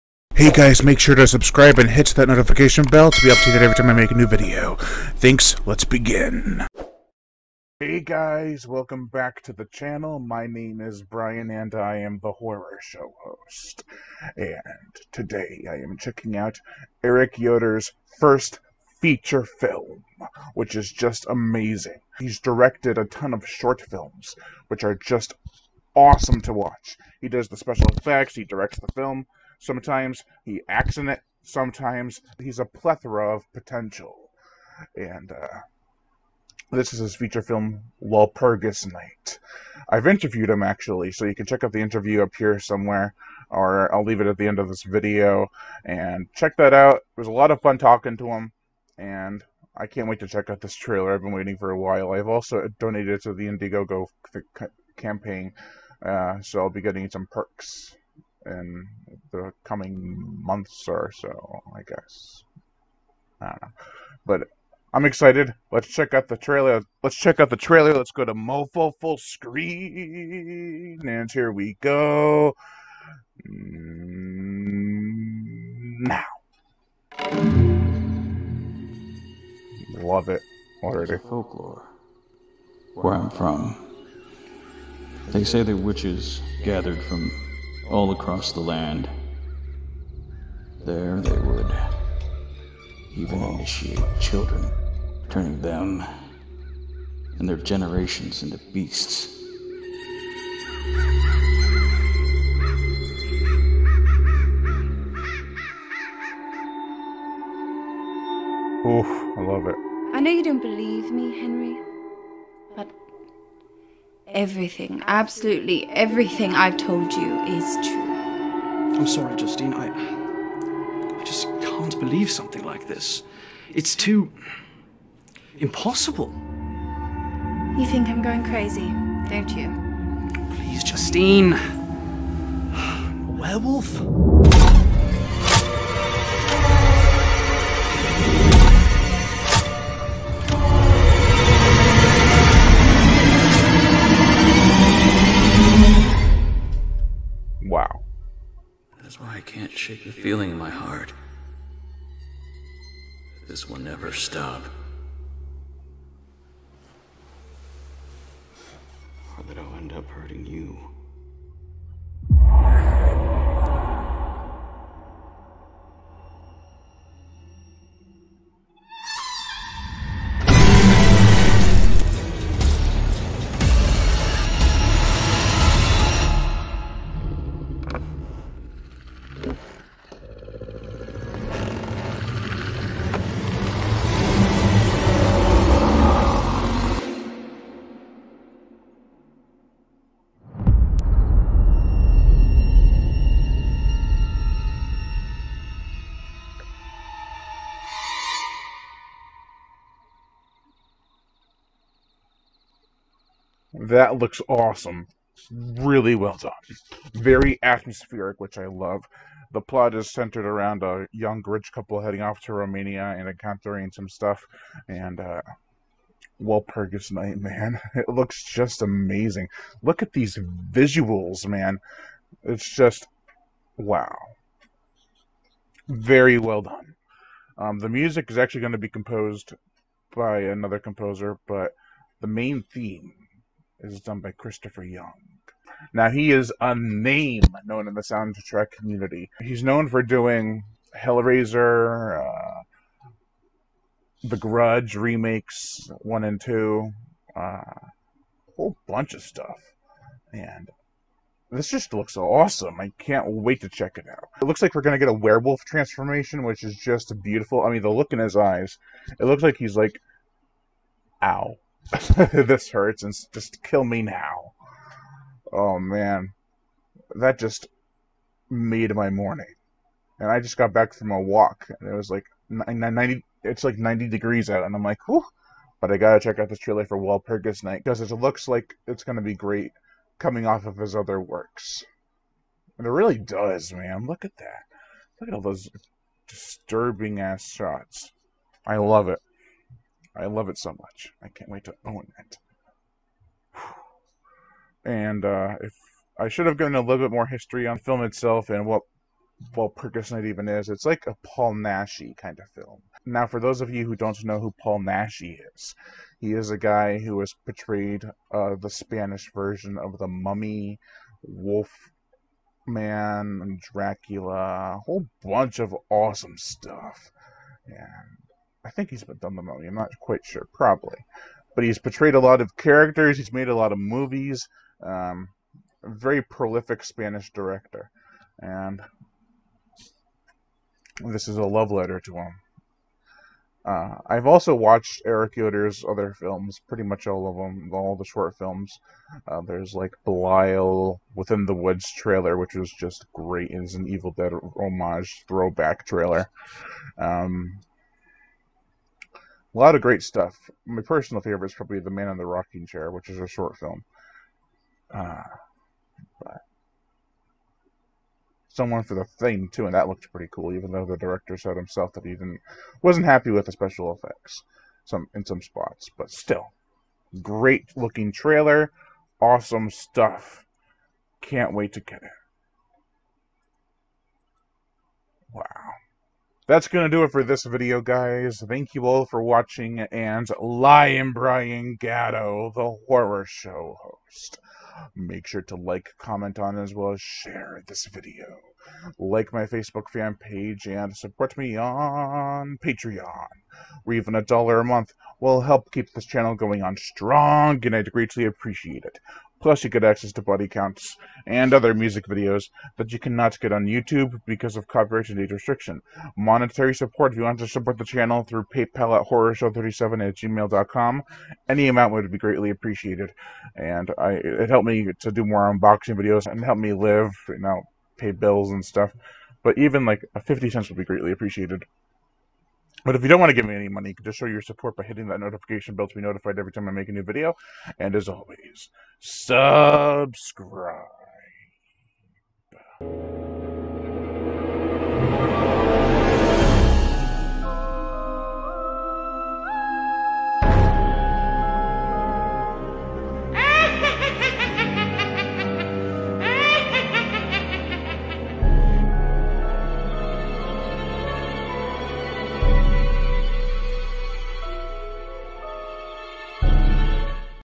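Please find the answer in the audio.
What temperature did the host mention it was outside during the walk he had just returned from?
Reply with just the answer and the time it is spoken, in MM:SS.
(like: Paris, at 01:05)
90 degrees, at 04:33.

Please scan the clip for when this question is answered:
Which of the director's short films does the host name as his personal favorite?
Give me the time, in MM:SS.
05:51.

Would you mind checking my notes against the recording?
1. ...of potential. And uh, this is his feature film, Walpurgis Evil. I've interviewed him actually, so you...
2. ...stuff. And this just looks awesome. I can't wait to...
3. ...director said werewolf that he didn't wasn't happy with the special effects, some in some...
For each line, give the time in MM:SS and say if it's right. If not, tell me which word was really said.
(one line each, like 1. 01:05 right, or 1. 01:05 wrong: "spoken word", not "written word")
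1. 00:33 wrong: "Night", not "Evil"
2. 04:09 right
3. 06:00 wrong: "himself", not "werewolf".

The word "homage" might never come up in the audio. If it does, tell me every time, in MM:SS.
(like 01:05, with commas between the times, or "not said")
05:44.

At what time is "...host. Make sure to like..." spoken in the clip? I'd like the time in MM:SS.
06:23.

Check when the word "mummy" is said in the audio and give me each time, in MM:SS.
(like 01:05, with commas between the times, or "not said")
05:10, 05:19.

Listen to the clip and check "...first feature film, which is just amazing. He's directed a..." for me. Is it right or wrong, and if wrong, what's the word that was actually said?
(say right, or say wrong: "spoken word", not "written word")
right.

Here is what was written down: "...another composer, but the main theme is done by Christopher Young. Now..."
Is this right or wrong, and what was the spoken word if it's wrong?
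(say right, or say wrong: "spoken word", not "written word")
right.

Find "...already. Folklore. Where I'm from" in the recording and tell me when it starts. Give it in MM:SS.
01:20.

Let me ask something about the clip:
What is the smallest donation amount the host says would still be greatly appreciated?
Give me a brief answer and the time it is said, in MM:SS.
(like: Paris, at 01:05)
50 cents, at 07:00.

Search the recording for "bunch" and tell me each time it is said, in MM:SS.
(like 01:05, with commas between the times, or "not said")
04:08, 05:15.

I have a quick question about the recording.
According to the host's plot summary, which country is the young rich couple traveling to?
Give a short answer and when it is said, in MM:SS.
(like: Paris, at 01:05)
Romania, at 03:32.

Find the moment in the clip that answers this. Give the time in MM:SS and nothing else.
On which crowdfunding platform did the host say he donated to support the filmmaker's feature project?
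00:53.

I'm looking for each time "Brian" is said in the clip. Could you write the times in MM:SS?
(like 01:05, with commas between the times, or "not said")
00:11, 06:21.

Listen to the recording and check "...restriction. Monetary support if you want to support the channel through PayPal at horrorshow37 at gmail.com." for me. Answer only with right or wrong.
right.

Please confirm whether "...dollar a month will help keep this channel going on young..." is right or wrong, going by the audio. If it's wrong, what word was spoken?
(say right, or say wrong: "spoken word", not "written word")
wrong: "strong", not "young".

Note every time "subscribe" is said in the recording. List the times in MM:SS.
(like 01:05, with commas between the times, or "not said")
00:01, 07:08.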